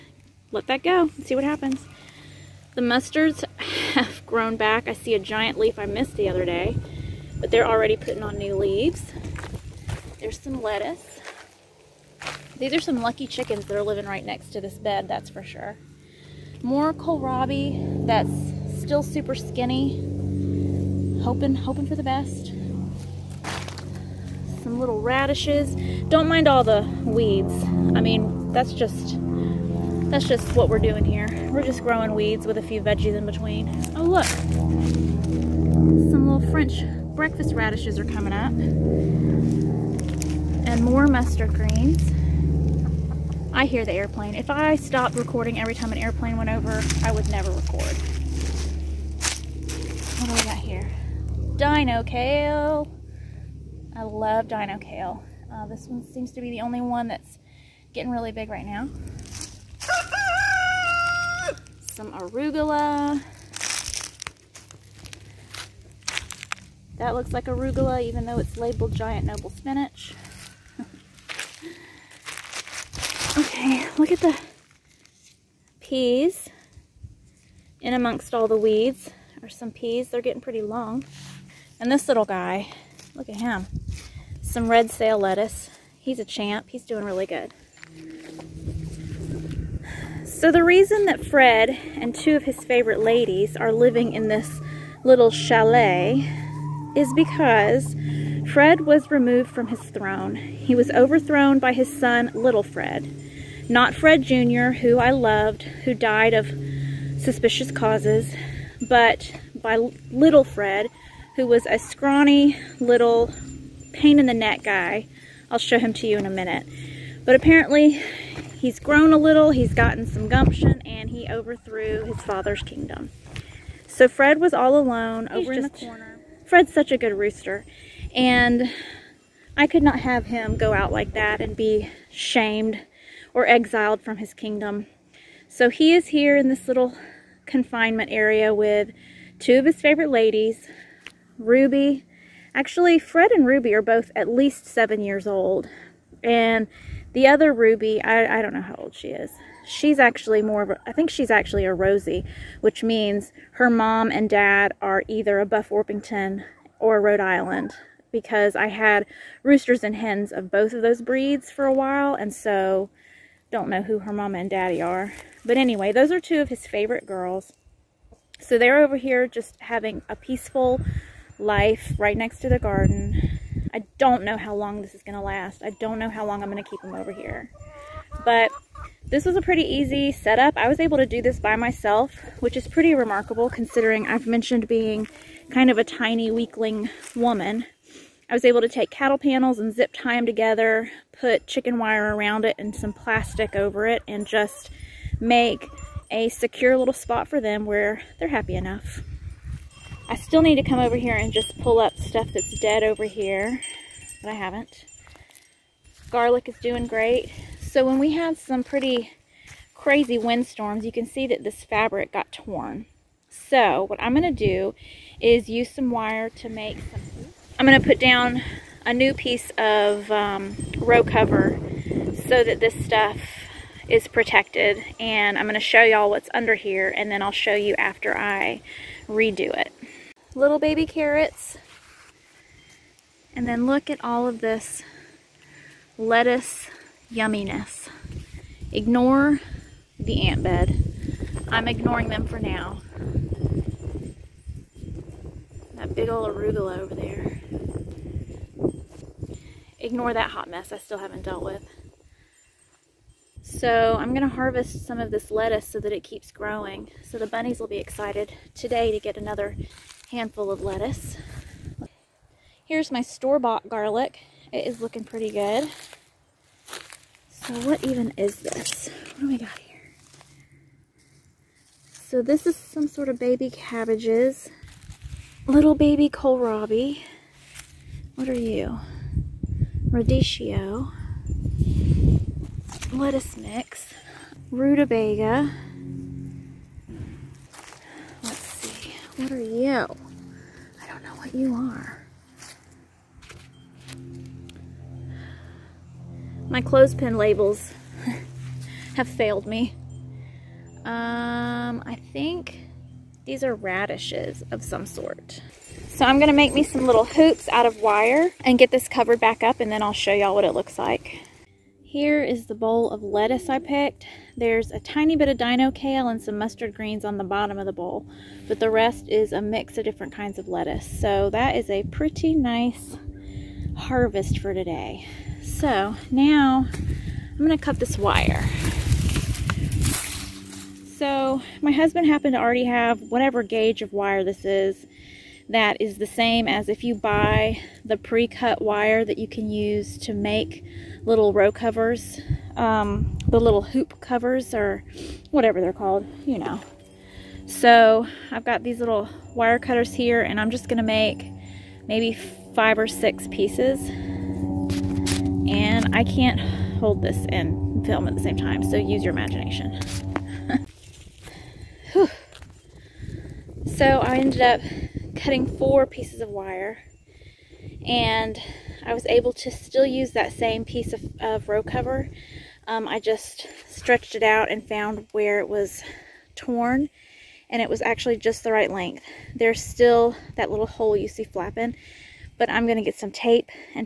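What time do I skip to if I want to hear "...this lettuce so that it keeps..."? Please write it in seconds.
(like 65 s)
255 s.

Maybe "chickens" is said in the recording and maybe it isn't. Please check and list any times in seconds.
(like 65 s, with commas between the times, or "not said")
13 s, 191 s.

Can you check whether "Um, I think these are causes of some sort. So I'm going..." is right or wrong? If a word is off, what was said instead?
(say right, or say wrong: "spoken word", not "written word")
wrong: "radishes", not "causes".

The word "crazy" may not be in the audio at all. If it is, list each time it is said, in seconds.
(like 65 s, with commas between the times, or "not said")
209 s.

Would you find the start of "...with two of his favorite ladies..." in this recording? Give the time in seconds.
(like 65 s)
138 s.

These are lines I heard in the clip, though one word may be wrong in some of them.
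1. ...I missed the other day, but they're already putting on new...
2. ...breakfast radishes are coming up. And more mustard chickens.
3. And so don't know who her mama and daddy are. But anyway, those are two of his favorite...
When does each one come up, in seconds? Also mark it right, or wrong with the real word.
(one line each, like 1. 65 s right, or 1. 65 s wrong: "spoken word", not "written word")
1. 5 s right
2. 37 s wrong: "greens", not "chickens"
3. 162 s right.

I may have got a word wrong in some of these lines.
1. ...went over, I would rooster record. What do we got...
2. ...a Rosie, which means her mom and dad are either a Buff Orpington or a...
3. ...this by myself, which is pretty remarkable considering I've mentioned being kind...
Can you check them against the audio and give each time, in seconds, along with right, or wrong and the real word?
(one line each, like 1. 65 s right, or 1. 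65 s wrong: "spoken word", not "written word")
1. 46 s wrong: "never", not "rooster"
2. 151 s right
3. 181 s right.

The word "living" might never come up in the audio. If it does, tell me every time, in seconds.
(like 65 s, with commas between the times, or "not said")
13 s, 93 s.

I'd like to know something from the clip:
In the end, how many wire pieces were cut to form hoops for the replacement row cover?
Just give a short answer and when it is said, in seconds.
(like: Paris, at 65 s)
4, at 365 s.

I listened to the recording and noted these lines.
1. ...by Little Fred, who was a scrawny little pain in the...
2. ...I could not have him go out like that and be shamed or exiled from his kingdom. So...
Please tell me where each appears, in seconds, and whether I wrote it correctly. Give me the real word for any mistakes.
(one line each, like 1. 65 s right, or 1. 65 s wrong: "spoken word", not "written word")
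1. 109 s right
2. 129 s right.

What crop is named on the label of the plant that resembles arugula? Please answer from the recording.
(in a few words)
giant noble spinach.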